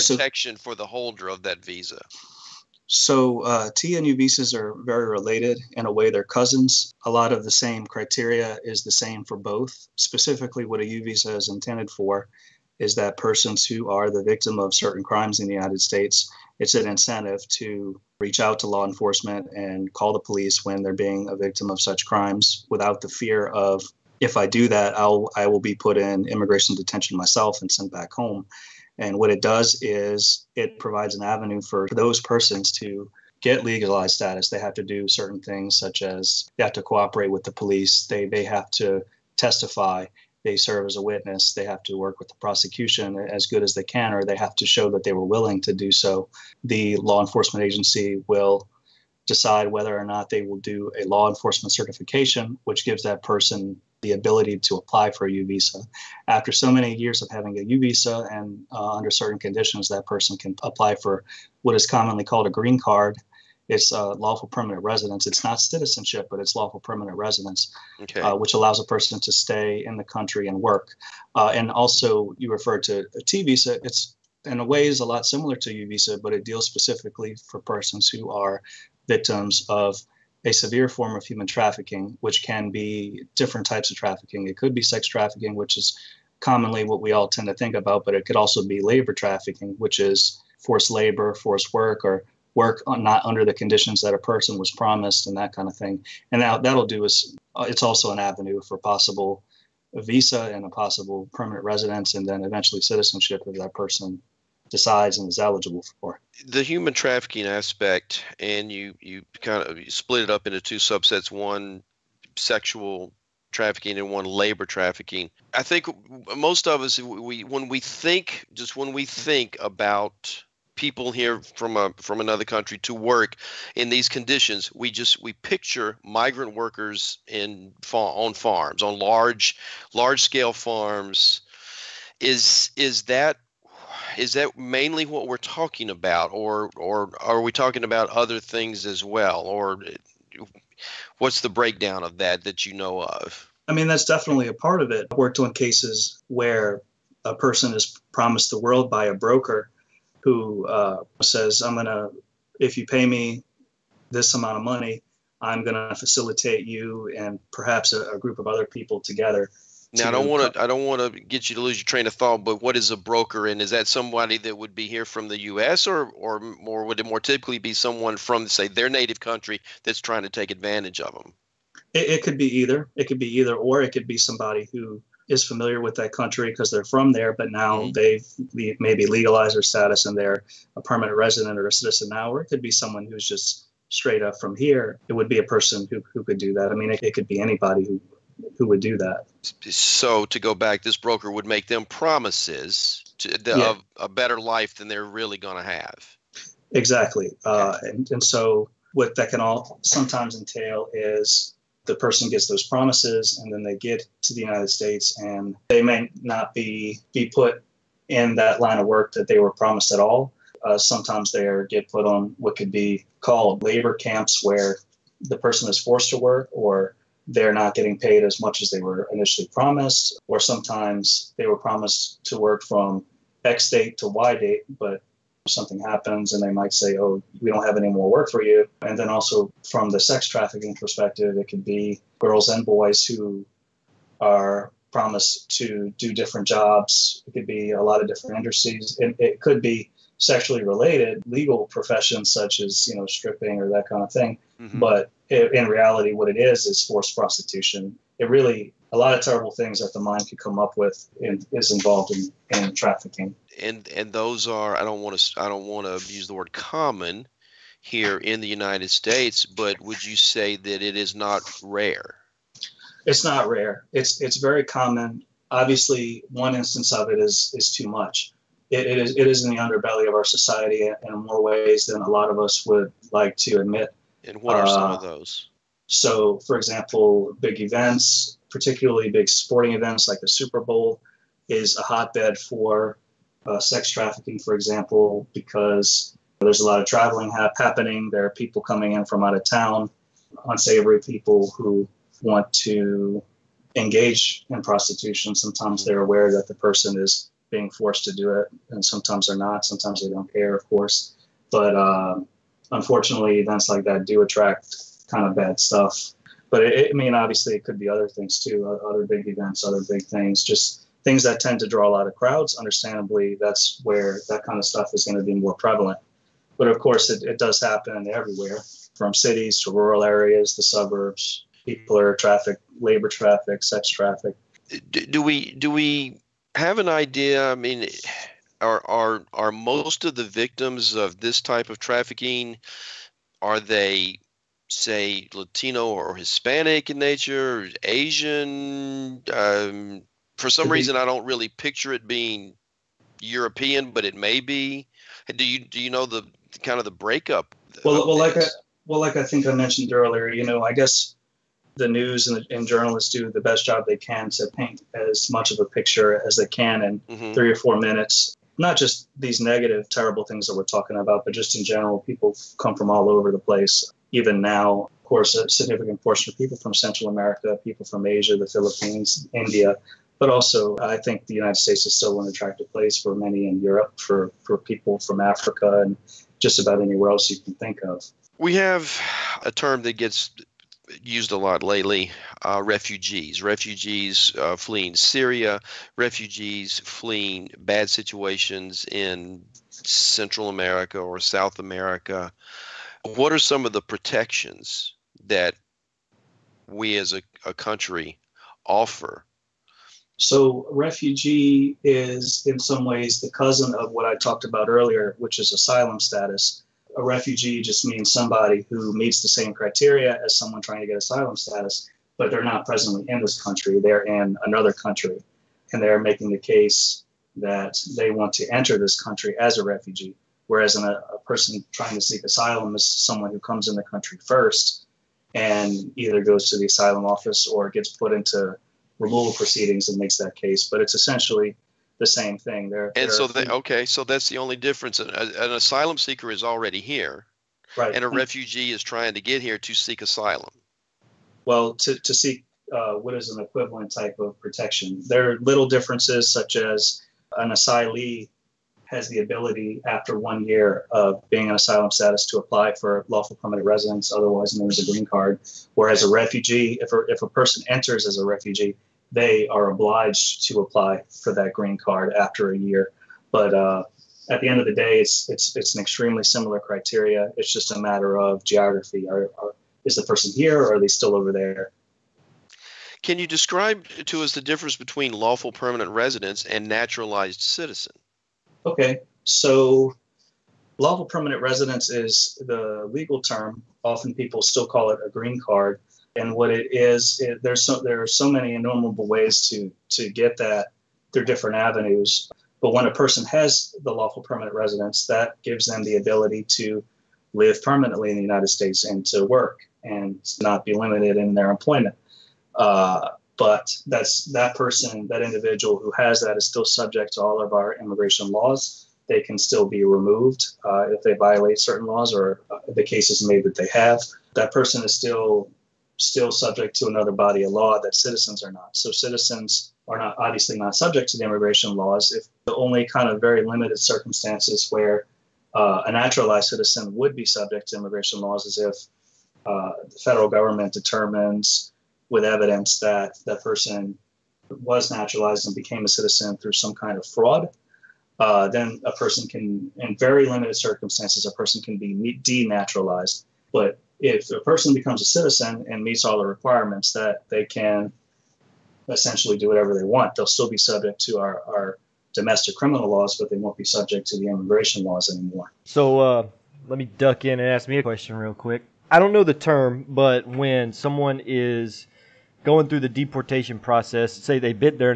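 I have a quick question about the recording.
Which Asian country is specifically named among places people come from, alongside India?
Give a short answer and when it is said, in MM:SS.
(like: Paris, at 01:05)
the Philippines, at 06:08.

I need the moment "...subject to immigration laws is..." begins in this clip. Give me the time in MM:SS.
08:47.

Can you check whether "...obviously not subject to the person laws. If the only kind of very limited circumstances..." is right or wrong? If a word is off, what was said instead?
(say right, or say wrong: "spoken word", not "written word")
wrong: "immigration", not "person".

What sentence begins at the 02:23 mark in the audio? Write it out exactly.
I mean, that's definitely a part of it.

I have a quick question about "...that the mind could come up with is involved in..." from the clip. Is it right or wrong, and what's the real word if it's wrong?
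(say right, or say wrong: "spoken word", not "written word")
right.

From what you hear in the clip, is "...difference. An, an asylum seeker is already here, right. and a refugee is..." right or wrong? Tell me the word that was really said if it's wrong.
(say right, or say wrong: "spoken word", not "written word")
right.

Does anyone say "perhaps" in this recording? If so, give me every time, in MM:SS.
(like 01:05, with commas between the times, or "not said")
02:37.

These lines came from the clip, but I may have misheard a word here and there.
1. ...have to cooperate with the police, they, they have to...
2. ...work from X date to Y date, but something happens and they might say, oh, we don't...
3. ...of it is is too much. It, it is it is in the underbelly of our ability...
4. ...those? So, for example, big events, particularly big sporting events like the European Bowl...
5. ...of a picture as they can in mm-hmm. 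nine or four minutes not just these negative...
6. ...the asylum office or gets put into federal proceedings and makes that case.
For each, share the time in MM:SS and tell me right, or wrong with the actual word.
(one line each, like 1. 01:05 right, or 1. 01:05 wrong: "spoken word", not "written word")
1. 00:36 right
2. 03:42 right
3. 04:26 wrong: "society", not "ability"
4. 04:35 wrong: "Super", not "European"
5. 05:55 wrong: "three", not "nine"
6. 07:06 wrong: "removal", not "federal".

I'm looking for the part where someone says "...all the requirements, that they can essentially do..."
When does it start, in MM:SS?
09:06.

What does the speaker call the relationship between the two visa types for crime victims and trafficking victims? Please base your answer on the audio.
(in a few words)
cousins.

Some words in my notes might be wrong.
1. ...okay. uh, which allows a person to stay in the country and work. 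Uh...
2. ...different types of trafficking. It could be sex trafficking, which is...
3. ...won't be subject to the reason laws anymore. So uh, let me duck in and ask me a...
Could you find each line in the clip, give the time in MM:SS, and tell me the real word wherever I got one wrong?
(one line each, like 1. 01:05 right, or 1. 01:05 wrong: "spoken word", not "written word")
1. 01:08 right
2. 01:23 right
3. 09:13 wrong: "immigration", not "reason".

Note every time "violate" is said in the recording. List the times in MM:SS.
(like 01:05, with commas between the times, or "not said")
08:31.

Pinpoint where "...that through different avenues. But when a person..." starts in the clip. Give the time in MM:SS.
08:10.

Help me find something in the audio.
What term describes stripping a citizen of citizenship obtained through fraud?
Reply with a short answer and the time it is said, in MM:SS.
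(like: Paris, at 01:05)
denaturalized, at 09:02.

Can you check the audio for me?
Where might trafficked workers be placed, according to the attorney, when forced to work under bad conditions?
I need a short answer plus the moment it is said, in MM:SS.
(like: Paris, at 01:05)
labor camps, at 03:33.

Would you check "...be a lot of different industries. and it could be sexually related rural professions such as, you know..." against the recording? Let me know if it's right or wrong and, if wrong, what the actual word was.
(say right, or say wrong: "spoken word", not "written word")
wrong: "legal", not "rural".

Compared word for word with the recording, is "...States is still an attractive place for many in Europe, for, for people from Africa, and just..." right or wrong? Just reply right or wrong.
right.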